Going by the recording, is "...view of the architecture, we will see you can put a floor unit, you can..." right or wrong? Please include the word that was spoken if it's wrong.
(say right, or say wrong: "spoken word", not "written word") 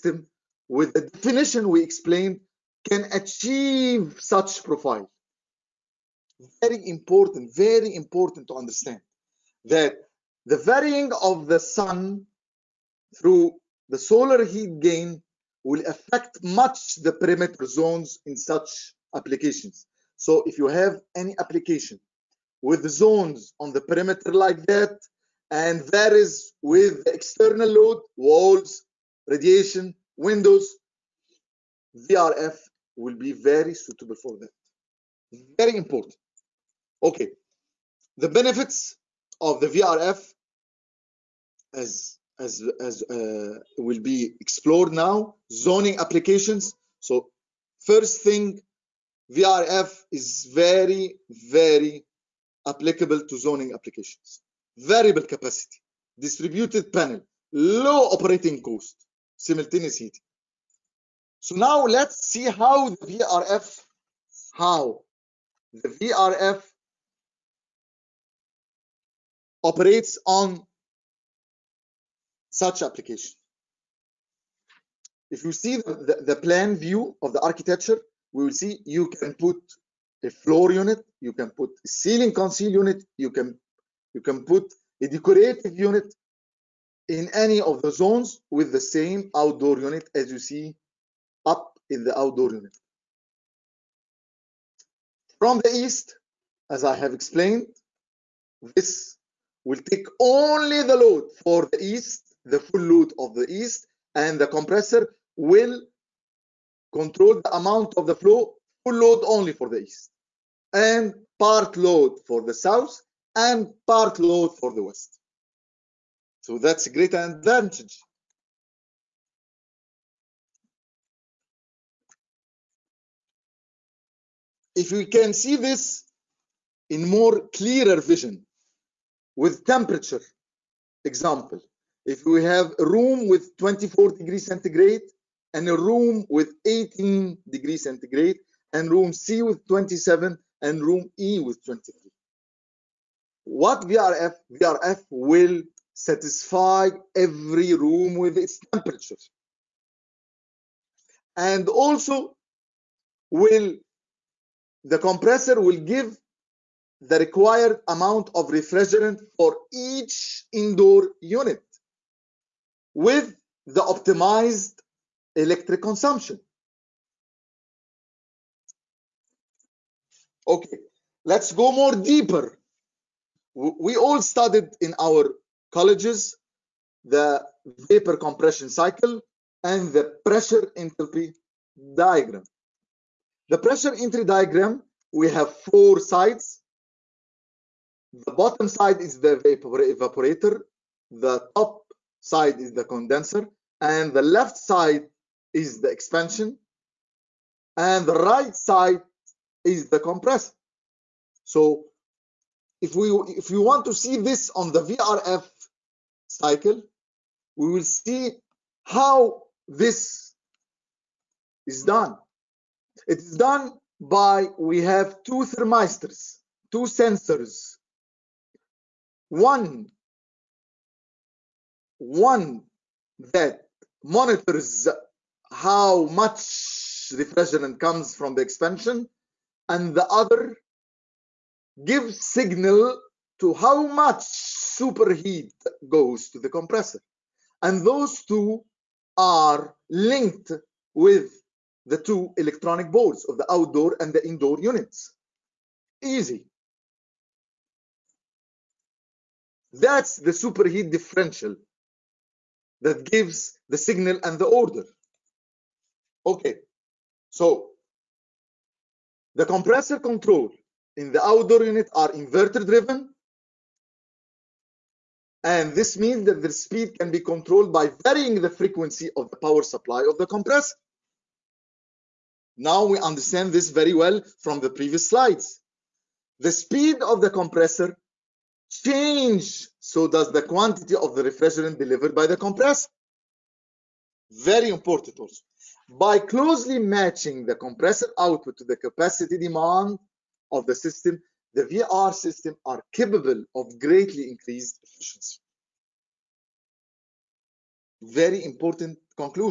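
right.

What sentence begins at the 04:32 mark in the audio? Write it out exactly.
Now we understand this very well from the previous slides.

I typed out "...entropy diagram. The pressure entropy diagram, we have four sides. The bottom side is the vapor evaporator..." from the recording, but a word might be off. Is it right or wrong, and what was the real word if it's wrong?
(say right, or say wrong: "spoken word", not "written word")
right.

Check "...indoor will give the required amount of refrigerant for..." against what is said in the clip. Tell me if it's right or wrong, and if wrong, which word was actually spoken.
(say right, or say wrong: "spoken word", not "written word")
wrong: "compressor", not "indoor".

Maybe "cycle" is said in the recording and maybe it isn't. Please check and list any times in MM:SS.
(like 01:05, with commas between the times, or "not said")
02:58, 03:26.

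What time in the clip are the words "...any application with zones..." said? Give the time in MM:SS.
00:21.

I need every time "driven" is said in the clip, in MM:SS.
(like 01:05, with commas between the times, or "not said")
04:22.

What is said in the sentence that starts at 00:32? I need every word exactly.
VRF will be very suitable for that.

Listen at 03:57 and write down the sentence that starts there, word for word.
And those two are linked with the two electronic boards of the outdoor and the indoor units.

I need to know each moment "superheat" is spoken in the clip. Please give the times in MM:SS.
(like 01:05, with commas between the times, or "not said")
03:54, 04:10.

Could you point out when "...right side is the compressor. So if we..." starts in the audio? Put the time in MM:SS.
03:18.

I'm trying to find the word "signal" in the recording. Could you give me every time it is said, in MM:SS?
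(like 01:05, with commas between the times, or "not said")
03:52, 04:13.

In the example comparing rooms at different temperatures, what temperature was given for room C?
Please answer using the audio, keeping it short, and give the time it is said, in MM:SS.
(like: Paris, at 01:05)
27, at 02:19.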